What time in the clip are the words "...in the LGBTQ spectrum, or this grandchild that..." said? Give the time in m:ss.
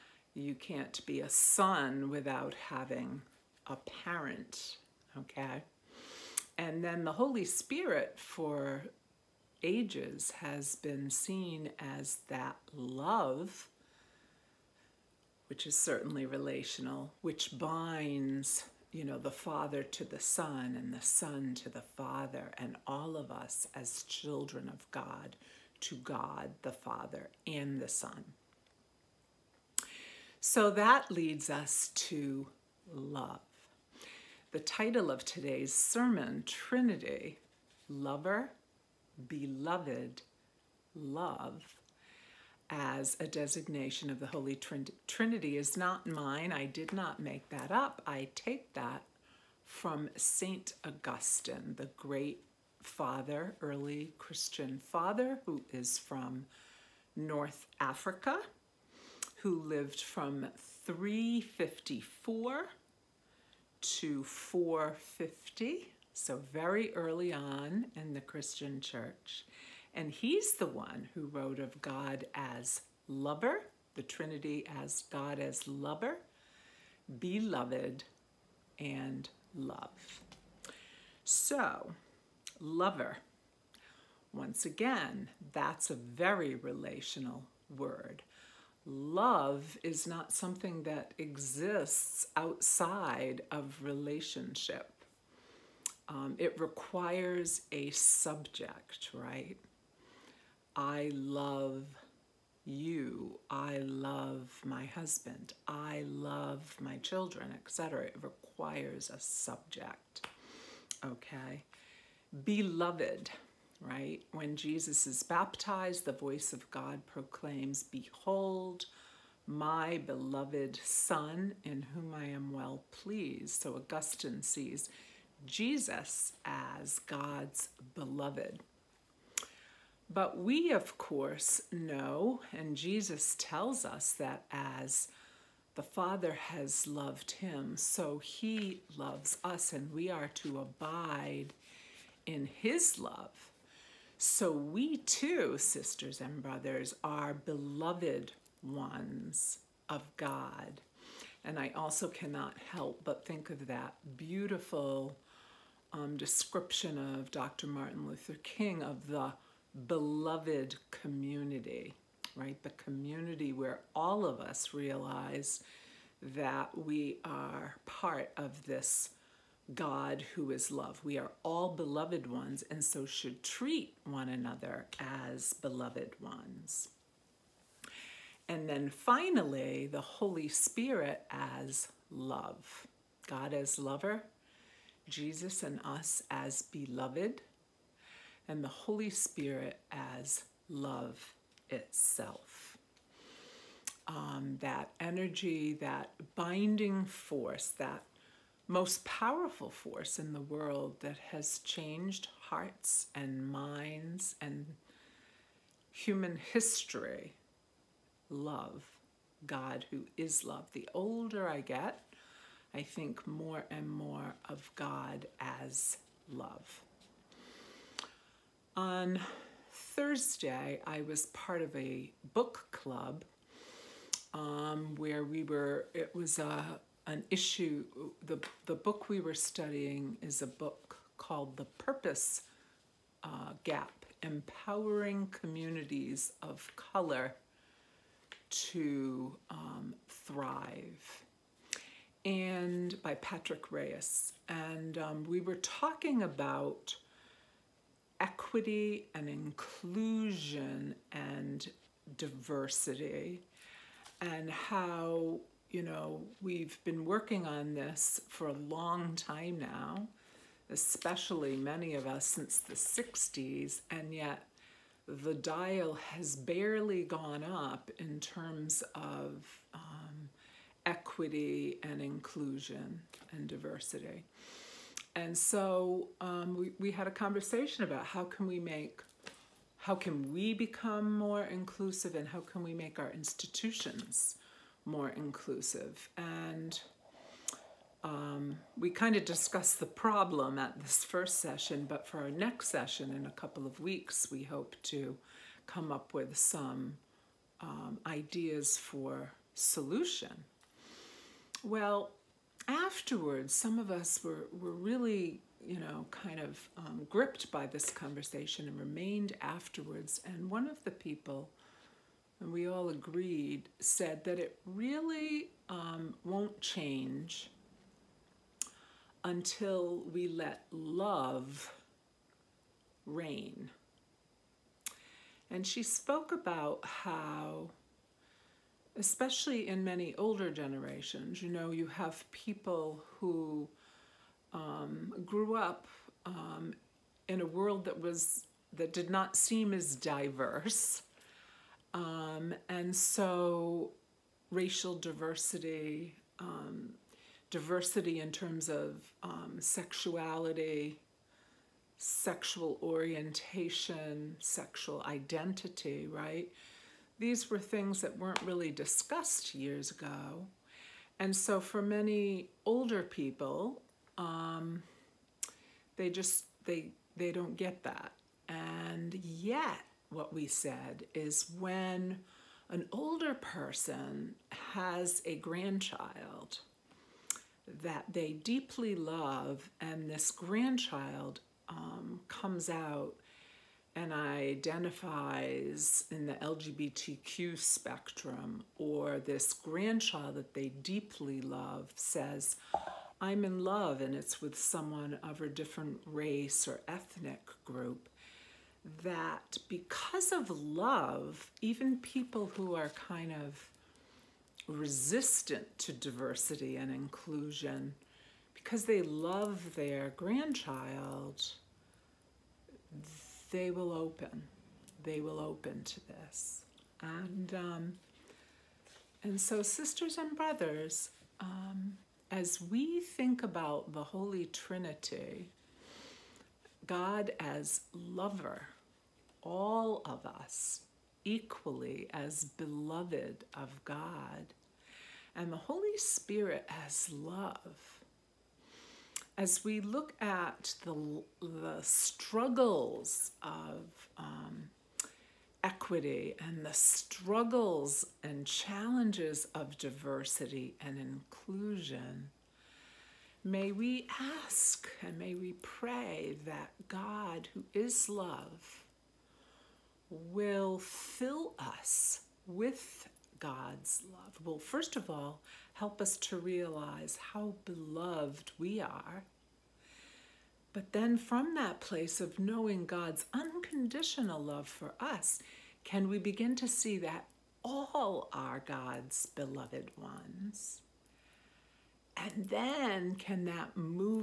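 6:26.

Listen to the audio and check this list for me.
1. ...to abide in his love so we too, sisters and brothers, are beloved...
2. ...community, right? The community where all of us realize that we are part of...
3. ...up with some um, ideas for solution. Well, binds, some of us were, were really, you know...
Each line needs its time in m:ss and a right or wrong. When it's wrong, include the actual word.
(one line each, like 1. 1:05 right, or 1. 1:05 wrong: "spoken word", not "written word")
1. 2:20 right
2. 2:40 right
3. 4:55 wrong: "afterwards", not "binds".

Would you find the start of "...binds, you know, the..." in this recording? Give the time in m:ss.
0:17.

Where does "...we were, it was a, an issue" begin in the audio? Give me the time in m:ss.
3:45.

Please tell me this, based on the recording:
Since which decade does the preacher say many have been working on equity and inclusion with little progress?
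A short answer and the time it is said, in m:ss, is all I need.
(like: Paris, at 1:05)
the 60s, at 4:22.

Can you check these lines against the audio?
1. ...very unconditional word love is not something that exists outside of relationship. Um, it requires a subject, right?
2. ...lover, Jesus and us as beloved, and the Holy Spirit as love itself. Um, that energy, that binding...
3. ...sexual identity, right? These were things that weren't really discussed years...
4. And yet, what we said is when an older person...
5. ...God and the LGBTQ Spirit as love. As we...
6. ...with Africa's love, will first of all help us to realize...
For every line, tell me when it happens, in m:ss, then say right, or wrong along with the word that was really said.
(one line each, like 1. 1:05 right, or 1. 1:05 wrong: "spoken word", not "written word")
1. 1:25 wrong: "relational", not "unconditional"
2. 3:03 right
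3. 5:54 right
4. 6:08 right
5. 7:13 wrong: "Holy", not "LGBTQ"
6. 7:42 wrong: "God", not "Africa".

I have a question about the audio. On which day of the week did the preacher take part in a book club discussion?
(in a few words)
Thursday.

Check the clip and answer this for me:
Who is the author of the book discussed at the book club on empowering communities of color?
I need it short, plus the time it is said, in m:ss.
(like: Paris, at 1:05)
Patrick Reyes, at 4:03.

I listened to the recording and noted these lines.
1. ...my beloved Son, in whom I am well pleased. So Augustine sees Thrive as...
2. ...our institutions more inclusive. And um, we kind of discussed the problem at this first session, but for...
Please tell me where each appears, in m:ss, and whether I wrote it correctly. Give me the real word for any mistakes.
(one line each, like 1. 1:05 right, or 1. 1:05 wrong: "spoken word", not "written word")
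1. 1:59 wrong: "Jesus", not "Thrive"
2. 4:42 right.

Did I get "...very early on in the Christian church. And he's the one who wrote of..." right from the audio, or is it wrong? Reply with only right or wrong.
right.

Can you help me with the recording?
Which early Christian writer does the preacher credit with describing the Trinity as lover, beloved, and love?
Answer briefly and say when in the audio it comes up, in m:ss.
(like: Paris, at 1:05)
St. Augustine, at 0:50.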